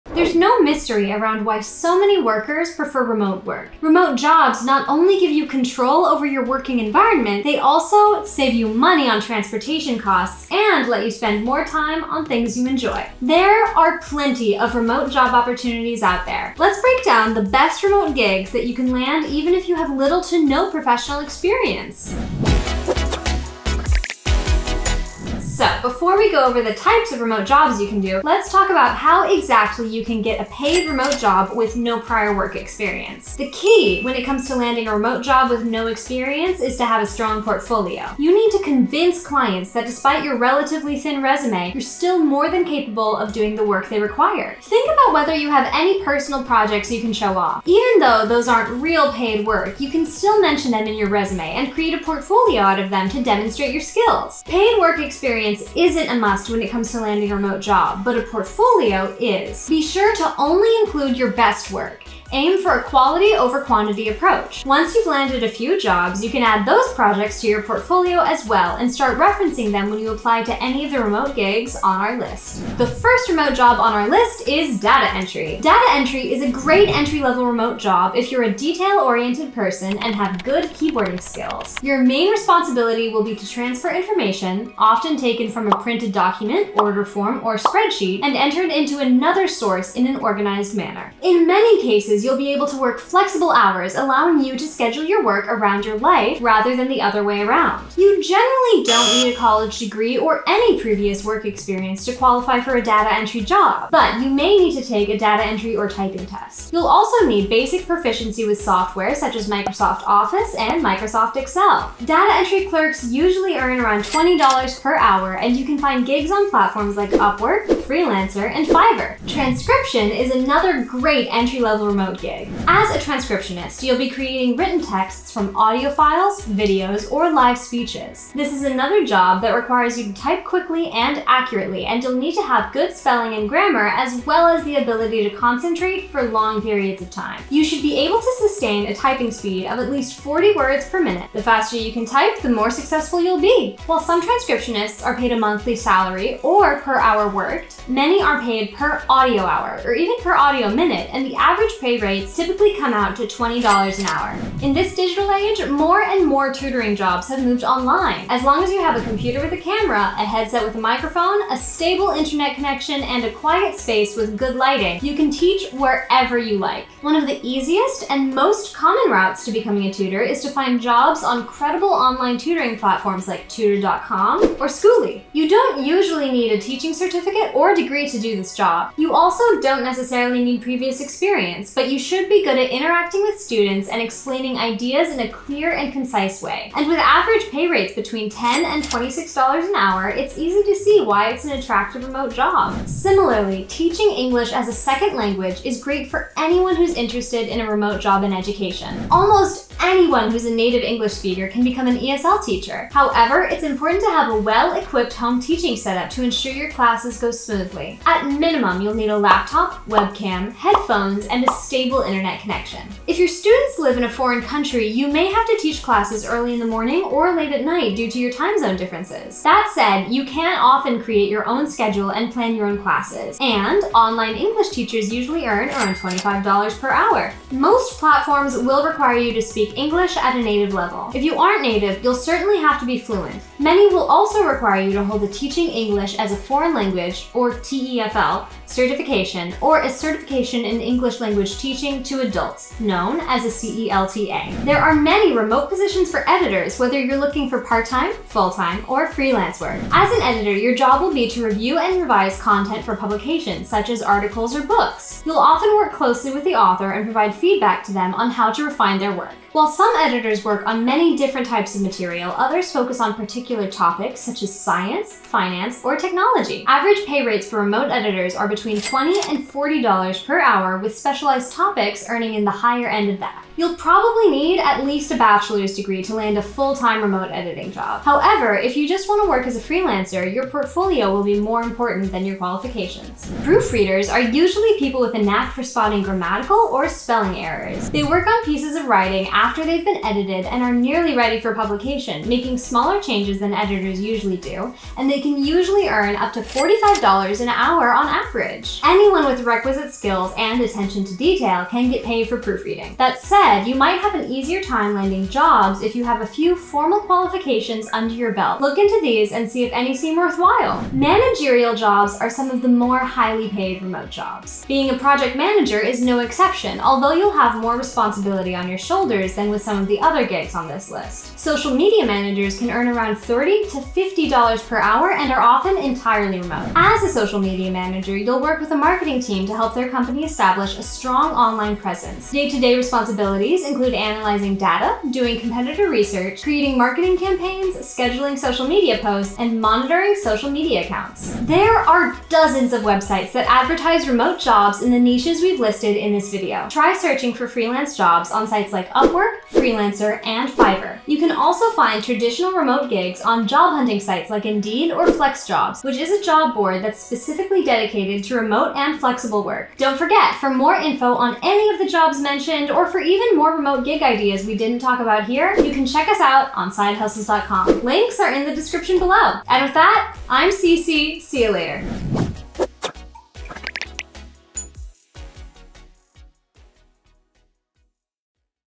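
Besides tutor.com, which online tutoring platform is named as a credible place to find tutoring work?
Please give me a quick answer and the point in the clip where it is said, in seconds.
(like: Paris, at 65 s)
Skooli, at 174 s.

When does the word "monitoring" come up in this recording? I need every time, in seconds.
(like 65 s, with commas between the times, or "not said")
339 s.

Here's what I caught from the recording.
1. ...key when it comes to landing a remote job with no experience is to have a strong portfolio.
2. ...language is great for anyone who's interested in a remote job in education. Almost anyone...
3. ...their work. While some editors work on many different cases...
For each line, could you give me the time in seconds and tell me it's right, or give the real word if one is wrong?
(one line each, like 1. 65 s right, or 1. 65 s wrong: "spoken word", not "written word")
1. 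33 s right
2. 195 s right
3. 258 s wrong: "types", not "cases".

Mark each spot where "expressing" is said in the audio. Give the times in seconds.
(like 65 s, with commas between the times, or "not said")
not said.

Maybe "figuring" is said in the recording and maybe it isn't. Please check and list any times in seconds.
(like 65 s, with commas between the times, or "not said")
not said.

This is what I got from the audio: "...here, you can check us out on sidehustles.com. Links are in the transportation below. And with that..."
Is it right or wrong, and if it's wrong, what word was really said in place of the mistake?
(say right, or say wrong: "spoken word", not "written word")
wrong: "description", not "transportation".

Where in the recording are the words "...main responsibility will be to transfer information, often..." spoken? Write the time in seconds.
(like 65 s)
82 s.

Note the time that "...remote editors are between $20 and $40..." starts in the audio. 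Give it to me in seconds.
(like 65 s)
267 s.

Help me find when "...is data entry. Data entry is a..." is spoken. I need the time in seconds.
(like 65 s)
74 s.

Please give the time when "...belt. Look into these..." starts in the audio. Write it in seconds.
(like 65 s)
308 s.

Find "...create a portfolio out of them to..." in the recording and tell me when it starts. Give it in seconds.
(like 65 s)
51 s.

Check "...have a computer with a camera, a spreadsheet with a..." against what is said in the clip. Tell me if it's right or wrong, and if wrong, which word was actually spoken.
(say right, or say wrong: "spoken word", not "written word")
wrong: "headset", not "spreadsheet".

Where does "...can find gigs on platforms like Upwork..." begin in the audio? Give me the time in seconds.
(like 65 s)
115 s.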